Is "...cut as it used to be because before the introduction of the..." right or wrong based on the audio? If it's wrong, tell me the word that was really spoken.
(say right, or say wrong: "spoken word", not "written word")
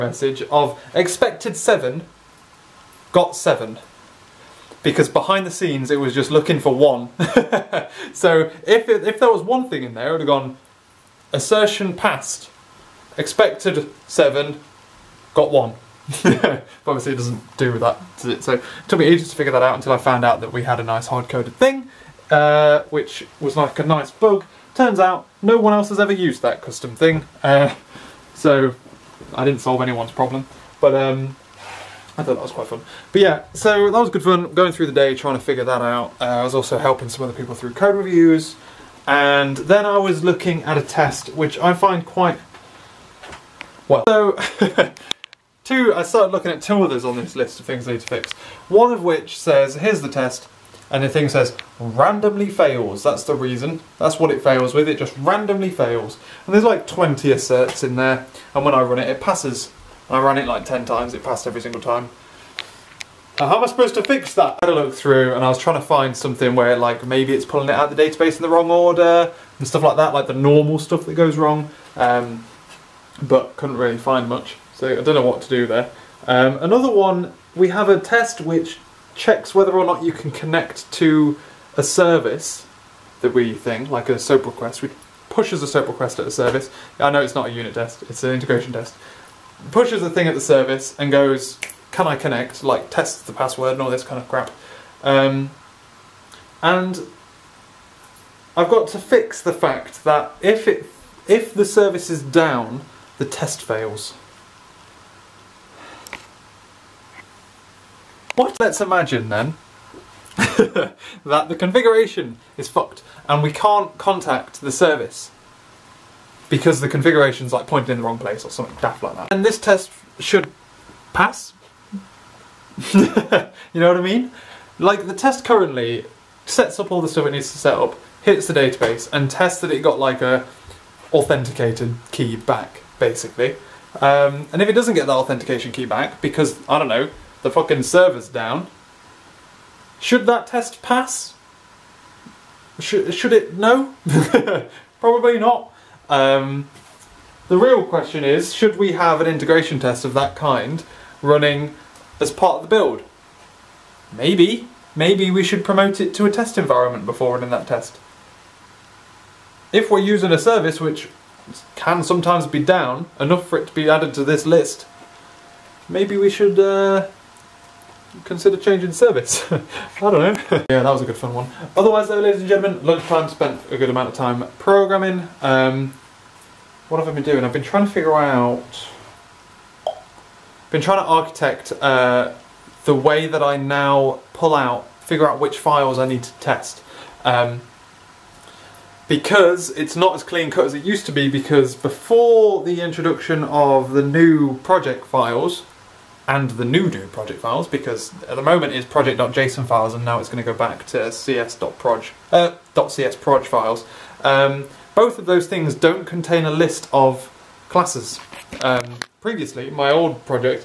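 right.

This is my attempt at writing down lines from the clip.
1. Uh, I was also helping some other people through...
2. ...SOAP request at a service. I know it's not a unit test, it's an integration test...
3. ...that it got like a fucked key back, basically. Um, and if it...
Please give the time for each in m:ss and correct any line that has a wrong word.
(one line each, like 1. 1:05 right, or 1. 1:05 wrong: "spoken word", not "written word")
1. 0:36 right
2. 1:25 right
3. 2:09 wrong: "authenticated", not "fucked".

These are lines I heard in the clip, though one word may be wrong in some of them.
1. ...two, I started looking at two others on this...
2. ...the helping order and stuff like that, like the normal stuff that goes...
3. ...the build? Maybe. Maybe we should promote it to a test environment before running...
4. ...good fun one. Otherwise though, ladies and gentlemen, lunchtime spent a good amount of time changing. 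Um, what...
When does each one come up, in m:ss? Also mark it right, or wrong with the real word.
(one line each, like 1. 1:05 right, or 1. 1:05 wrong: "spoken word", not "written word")
1. 0:45 right
2. 1:08 wrong: "wrong", not "helping"
3. 2:32 right
4. 2:51 wrong: "programming", not "changing".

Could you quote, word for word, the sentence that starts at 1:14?
So I don't know what to do there.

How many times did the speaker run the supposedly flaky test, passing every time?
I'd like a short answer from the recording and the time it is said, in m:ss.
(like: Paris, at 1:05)
10, at 1:00.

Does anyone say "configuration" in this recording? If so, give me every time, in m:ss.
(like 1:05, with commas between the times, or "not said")
1:51, 1:56.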